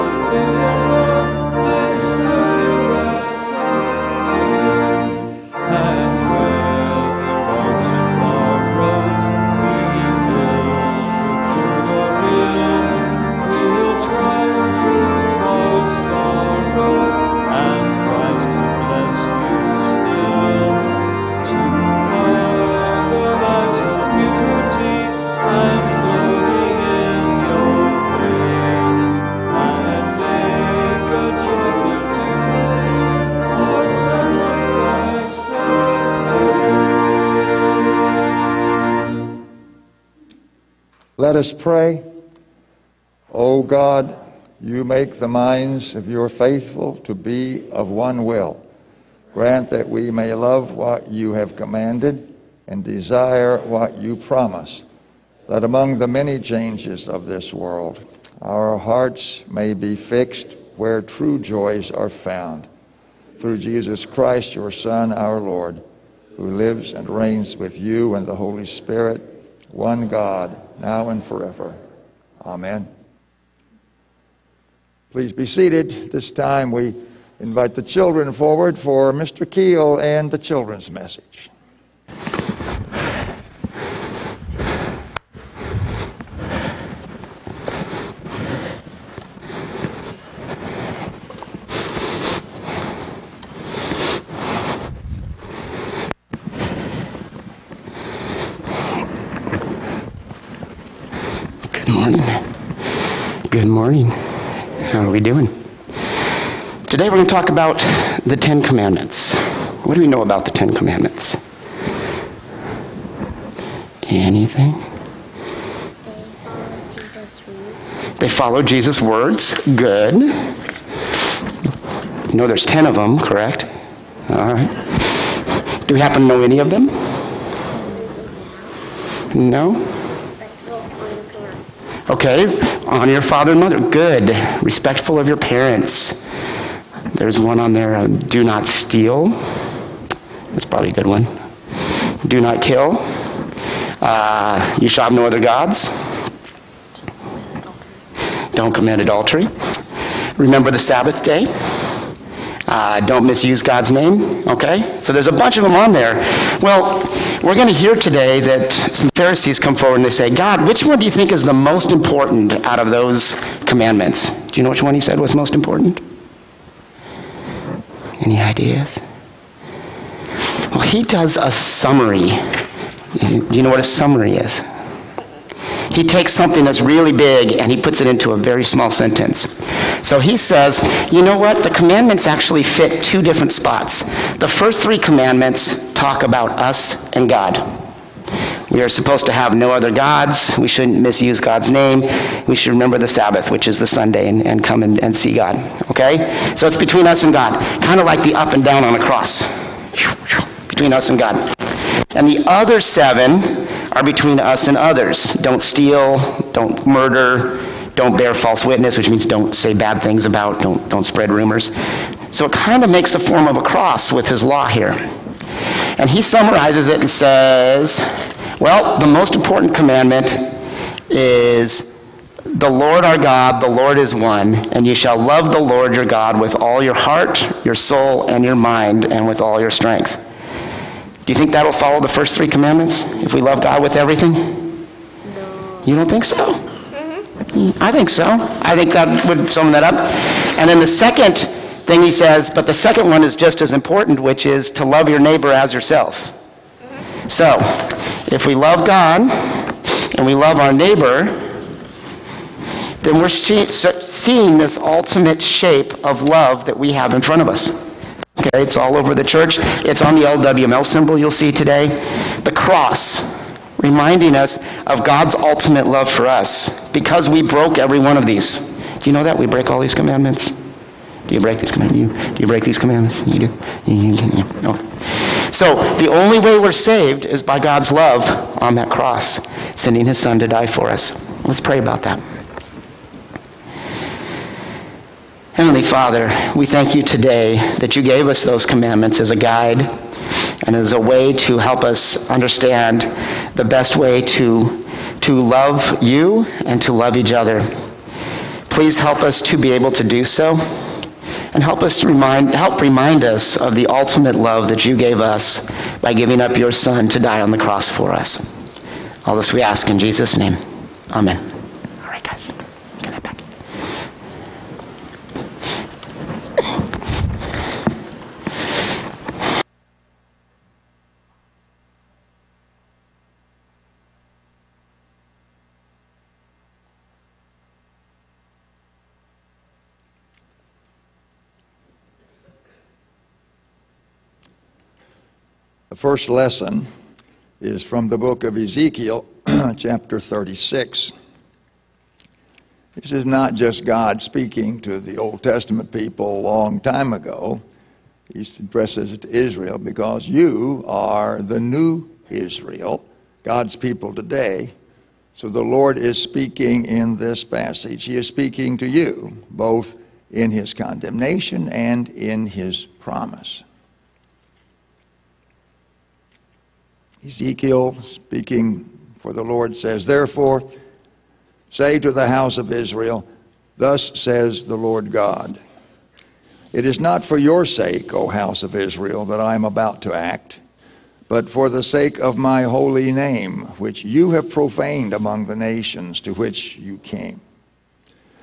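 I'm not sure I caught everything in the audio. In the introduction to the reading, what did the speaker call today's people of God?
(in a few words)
the new Israel.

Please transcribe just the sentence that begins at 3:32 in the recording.
So it kind of makes the form of a cross with his law here.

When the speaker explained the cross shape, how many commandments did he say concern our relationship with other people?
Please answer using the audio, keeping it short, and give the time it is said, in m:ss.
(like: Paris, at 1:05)
7, at 3:22.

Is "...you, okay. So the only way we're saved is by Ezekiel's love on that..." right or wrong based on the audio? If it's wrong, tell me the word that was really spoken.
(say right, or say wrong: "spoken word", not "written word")
wrong: "God", not "Ezekiel".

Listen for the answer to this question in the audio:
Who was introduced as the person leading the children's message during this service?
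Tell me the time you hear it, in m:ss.
1:19.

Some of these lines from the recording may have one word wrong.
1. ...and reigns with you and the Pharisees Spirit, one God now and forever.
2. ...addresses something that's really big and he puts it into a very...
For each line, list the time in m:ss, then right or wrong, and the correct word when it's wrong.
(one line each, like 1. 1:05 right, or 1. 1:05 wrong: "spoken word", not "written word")
1. 1:06 wrong: "Holy", not "Pharisees"
2. 2:56 wrong: "takes", not "addresses".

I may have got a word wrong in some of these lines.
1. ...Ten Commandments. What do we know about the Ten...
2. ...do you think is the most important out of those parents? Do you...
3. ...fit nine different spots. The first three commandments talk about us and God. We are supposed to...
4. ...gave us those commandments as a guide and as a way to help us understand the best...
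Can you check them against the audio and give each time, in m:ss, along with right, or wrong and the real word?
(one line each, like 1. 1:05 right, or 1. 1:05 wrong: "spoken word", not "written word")
1. 1:48 right
2. 2:40 wrong: "commandments", not "parents"
3. 3:02 wrong: "two", not "nine"
4. 4:48 right.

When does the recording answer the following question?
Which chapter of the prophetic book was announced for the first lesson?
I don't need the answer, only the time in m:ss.
5:40.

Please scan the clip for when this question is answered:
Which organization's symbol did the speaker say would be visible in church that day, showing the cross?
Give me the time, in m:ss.
4:20.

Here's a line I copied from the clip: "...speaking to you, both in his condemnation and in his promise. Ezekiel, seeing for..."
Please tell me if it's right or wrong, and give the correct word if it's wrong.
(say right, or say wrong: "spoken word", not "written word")
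wrong: "speaking", not "seeing".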